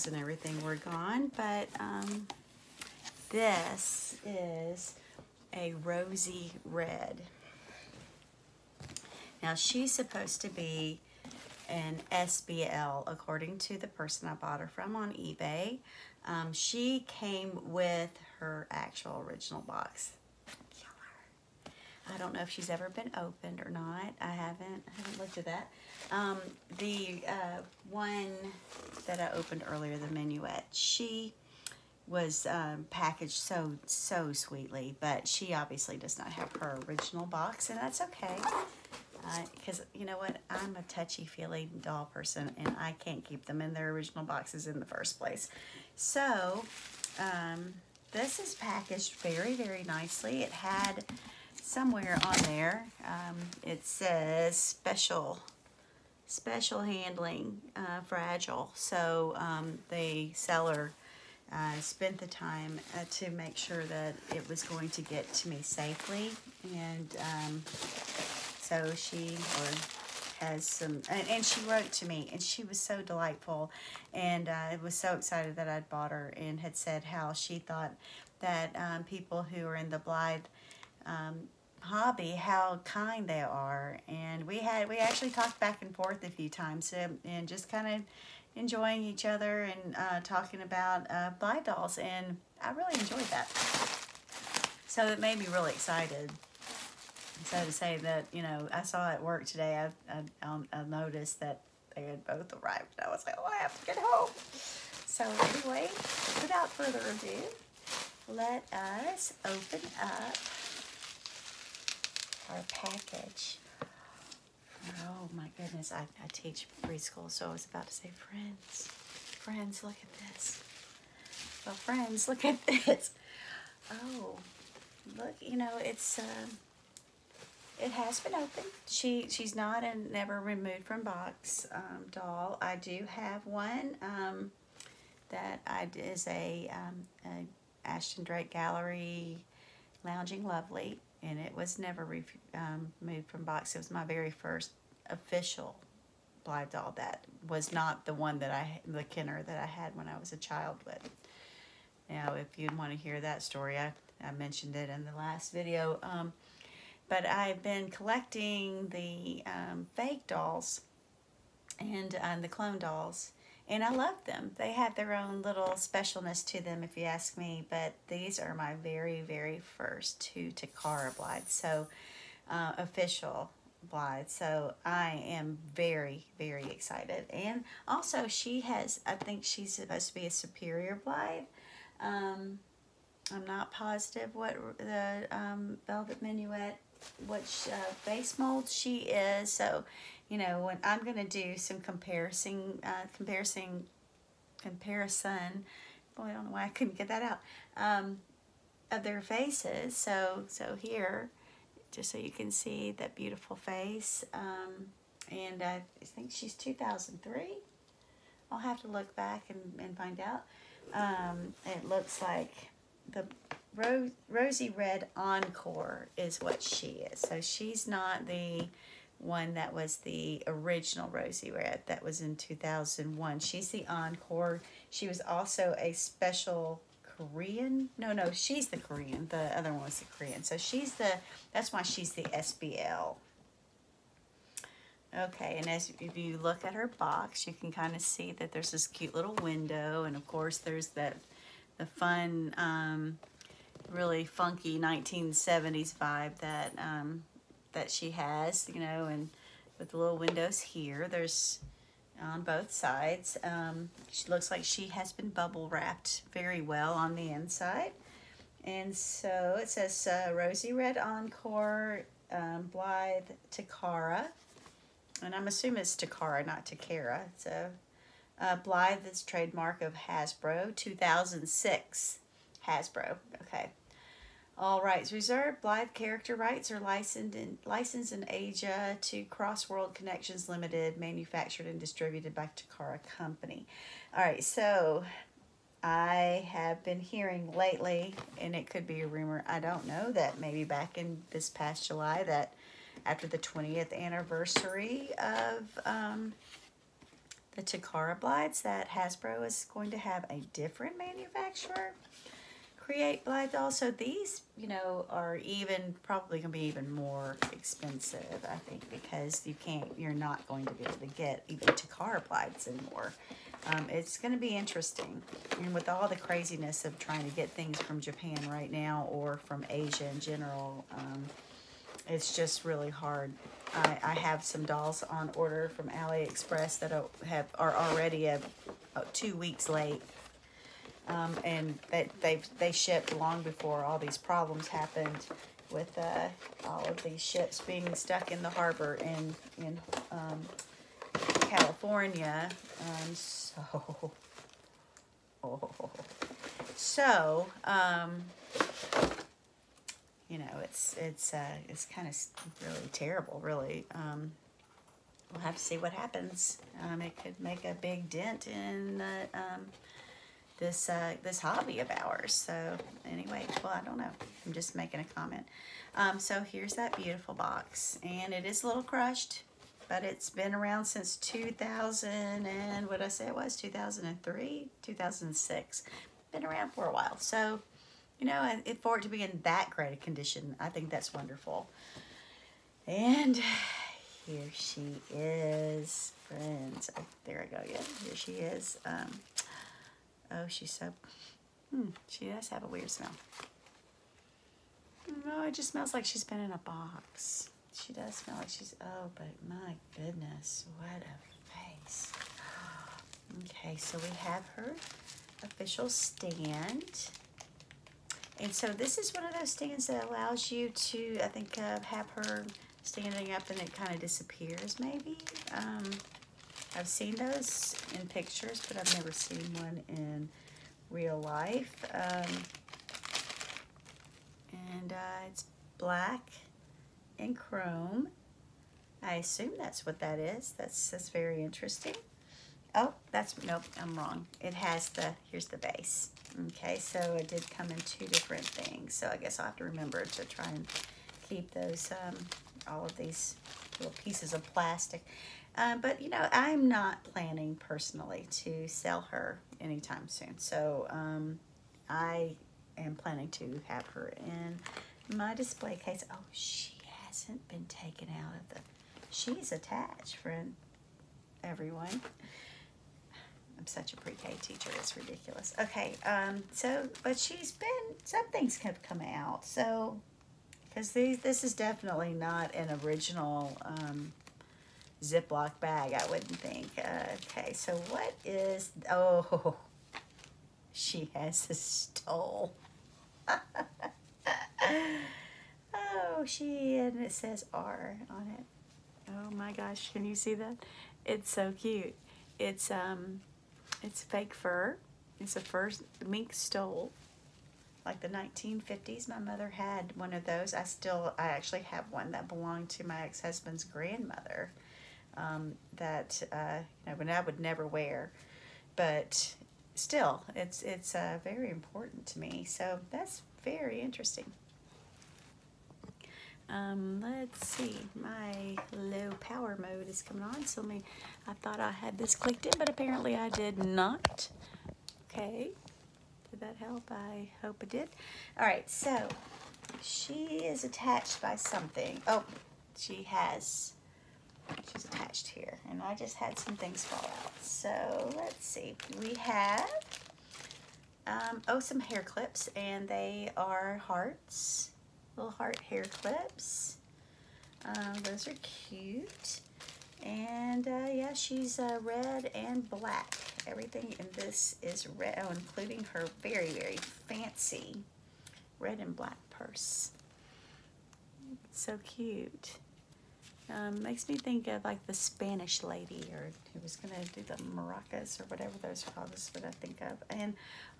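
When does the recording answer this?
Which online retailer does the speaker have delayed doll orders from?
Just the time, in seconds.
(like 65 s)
325 s.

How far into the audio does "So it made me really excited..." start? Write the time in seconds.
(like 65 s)
94 s.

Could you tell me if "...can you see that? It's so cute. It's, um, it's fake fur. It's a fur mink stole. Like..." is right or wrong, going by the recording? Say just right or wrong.
right.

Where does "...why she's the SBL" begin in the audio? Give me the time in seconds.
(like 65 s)
231 s.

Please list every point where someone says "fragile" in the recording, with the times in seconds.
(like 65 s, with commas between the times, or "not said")
58 s.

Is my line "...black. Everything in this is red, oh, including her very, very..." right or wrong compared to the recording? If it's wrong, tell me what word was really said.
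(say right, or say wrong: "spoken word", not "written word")
right.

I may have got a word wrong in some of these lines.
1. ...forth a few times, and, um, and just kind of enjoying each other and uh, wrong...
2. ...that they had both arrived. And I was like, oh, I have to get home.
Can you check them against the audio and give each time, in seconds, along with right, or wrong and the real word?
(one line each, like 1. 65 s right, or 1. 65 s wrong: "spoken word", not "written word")
1. 85 s wrong: "talking", not "wrong"
2. 101 s right.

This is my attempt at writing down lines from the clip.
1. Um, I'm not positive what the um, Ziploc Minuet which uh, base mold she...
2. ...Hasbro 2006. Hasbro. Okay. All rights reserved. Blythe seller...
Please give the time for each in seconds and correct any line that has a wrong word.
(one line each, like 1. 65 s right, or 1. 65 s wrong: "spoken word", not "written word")
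1. 182 s wrong: "Velvet", not "Ziploc"
2. 269 s wrong: "character", not "seller".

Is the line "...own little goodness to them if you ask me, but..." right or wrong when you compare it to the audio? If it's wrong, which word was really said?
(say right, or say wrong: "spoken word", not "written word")
wrong: "specialness", not "goodness".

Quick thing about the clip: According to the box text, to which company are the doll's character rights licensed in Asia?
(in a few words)
Cross World Connections Limited.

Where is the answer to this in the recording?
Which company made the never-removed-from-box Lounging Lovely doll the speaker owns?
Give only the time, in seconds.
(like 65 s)
137 s.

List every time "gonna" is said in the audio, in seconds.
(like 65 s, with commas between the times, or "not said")
306 s, 314 s.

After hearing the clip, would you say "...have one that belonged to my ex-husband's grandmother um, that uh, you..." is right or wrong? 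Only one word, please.
right.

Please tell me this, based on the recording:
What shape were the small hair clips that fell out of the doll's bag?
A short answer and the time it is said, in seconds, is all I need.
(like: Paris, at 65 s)
hearts, at 543 s.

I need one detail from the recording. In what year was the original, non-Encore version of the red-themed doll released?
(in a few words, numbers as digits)
2001.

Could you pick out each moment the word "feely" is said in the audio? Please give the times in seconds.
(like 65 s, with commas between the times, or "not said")
40 s.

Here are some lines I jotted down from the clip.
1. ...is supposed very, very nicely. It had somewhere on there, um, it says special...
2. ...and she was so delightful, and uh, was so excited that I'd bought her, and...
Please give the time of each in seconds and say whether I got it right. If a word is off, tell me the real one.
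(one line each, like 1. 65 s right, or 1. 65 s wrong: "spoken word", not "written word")
1. 48 s wrong: "packaged", not "supposed"
2. 72 s right.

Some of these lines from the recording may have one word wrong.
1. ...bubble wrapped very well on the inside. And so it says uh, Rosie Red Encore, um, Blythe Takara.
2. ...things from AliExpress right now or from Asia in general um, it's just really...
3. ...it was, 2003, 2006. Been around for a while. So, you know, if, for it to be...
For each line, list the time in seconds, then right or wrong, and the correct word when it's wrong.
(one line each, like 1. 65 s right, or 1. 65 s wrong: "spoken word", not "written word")
1. 255 s right
2. 317 s wrong: "Japan", not "AliExpress"
3. 373 s right.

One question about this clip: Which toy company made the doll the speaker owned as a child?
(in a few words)
Kenner.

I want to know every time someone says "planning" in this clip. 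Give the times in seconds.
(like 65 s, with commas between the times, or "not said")
447 s, 452 s.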